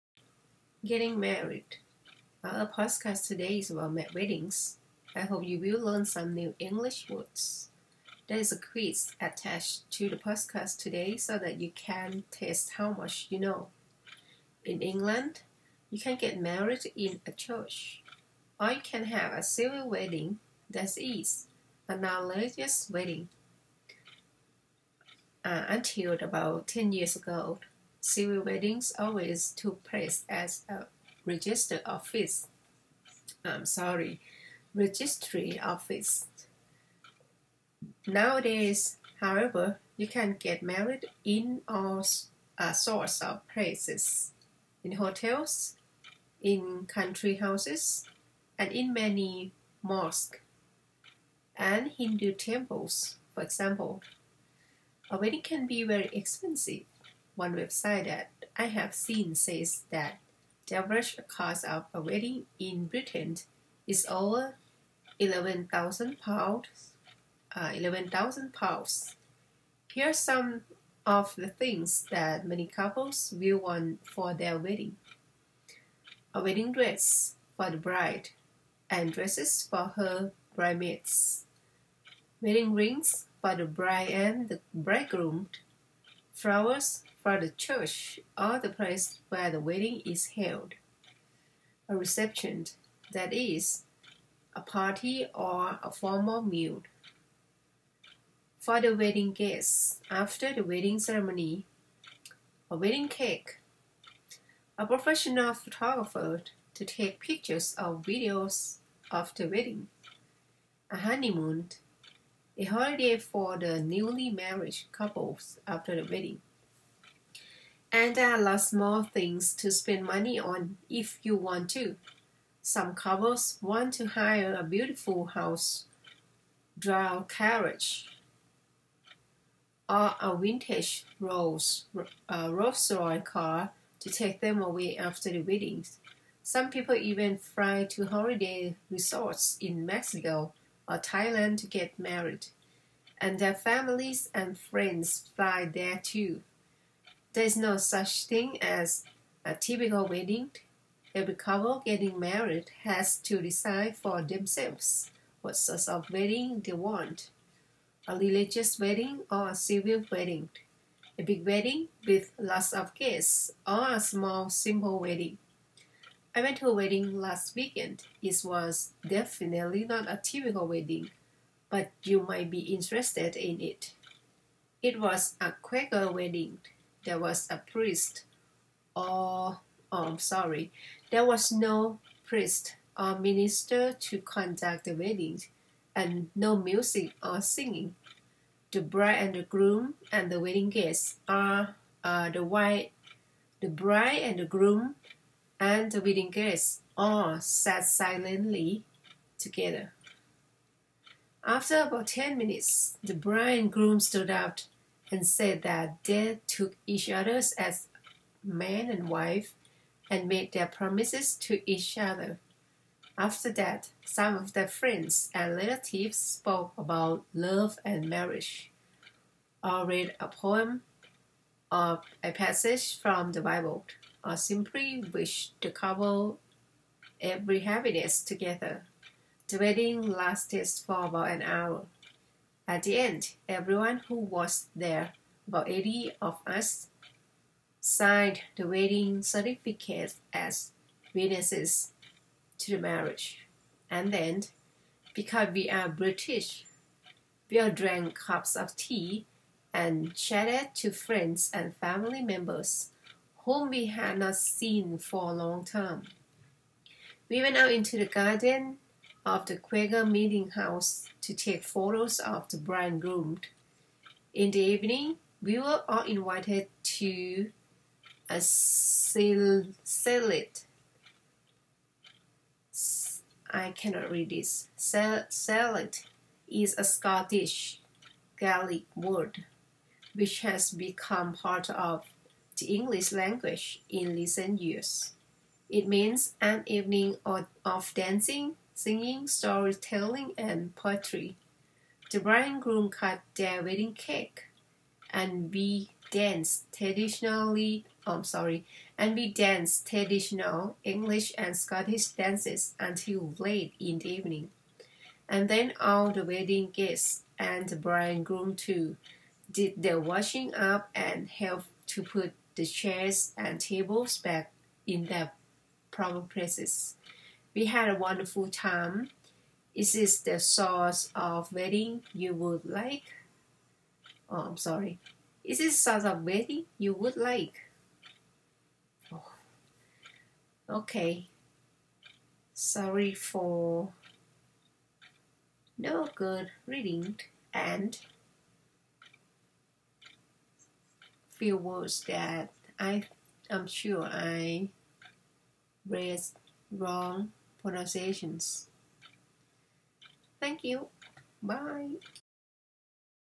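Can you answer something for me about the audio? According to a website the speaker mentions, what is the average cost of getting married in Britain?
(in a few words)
over £11,000.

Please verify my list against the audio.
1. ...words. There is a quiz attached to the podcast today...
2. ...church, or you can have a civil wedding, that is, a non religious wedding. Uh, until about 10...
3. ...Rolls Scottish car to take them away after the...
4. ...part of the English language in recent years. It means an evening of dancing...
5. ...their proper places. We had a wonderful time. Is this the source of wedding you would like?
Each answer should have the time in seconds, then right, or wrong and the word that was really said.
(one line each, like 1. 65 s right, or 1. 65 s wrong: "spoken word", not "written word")
1. 7 s right
2. 17 s right
3. 132 s wrong: "Royce", not "Scottish"
4. 281 s right
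5. 315 s right.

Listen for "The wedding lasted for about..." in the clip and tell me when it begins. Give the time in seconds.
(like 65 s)
229 s.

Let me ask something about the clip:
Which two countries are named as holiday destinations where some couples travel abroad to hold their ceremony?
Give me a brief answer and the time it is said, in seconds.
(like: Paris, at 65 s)
Mexico or Thailand, at 139 s.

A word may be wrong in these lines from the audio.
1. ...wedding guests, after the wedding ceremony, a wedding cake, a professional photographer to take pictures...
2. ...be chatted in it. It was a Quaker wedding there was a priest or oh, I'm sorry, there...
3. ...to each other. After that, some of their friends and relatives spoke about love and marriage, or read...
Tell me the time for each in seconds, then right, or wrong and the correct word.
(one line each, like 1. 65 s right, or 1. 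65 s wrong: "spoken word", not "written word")
1. 98 s right
2. 172 s wrong: "interested", not "chatted"
3. 211 s right.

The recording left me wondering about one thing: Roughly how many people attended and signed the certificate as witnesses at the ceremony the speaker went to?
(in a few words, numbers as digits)
about 80.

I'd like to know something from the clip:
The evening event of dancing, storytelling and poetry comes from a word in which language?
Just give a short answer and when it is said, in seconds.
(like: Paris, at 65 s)
Scottish Gaelic, at 276 s.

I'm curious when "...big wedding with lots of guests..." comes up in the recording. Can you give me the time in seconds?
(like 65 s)
161 s.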